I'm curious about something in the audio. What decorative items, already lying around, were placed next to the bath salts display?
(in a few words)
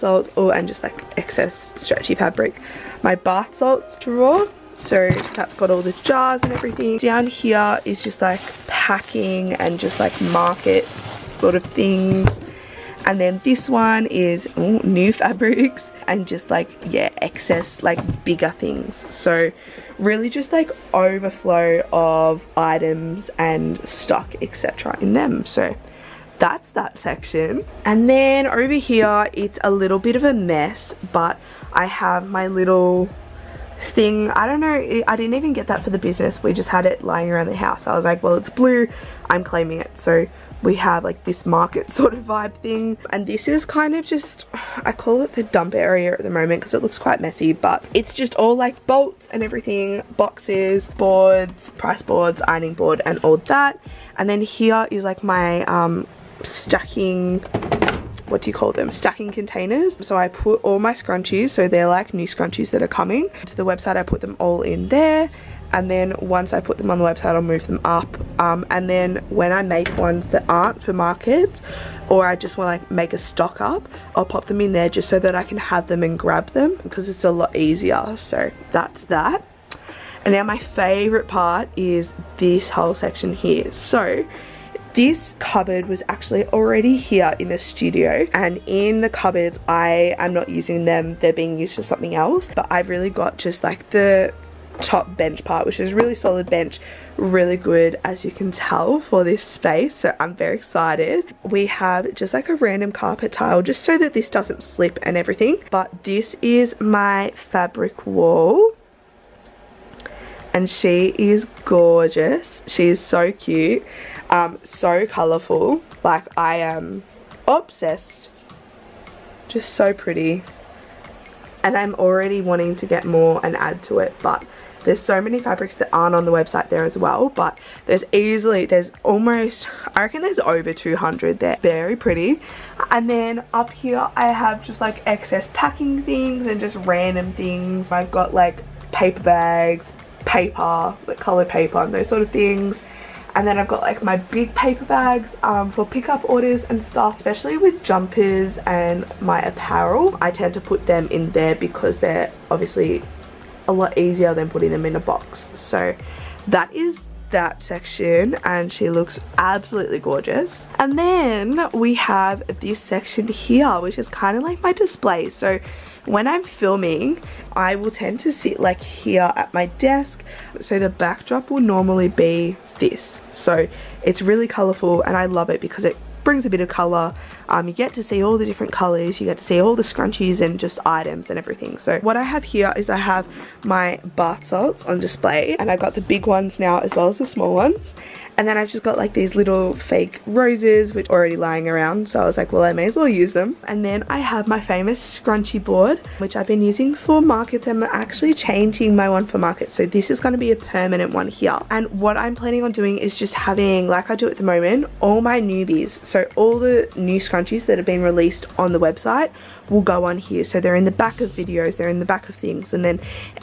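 Fake roses.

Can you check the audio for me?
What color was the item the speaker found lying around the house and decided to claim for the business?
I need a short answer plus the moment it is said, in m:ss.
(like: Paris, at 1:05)
Blue, at 0:38.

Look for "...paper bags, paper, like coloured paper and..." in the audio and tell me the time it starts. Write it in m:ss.
2:18.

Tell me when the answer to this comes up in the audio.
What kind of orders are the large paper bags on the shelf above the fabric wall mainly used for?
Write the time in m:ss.
2:25.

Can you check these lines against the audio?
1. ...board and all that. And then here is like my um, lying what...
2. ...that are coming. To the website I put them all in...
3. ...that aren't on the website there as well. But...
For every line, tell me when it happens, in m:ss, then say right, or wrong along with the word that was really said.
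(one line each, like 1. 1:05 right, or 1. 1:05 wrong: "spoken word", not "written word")
1. 0:52 wrong: "stacking", not "lying"
2. 1:02 right
3. 2:05 right.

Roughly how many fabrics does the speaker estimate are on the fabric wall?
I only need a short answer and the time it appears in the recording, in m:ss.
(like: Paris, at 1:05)
Over 200, at 2:10.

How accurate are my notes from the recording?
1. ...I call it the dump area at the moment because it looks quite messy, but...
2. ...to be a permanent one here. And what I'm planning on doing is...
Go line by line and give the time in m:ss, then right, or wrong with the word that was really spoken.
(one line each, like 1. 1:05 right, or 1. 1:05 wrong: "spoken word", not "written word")
1. 0:44 right
2. 3:20 right.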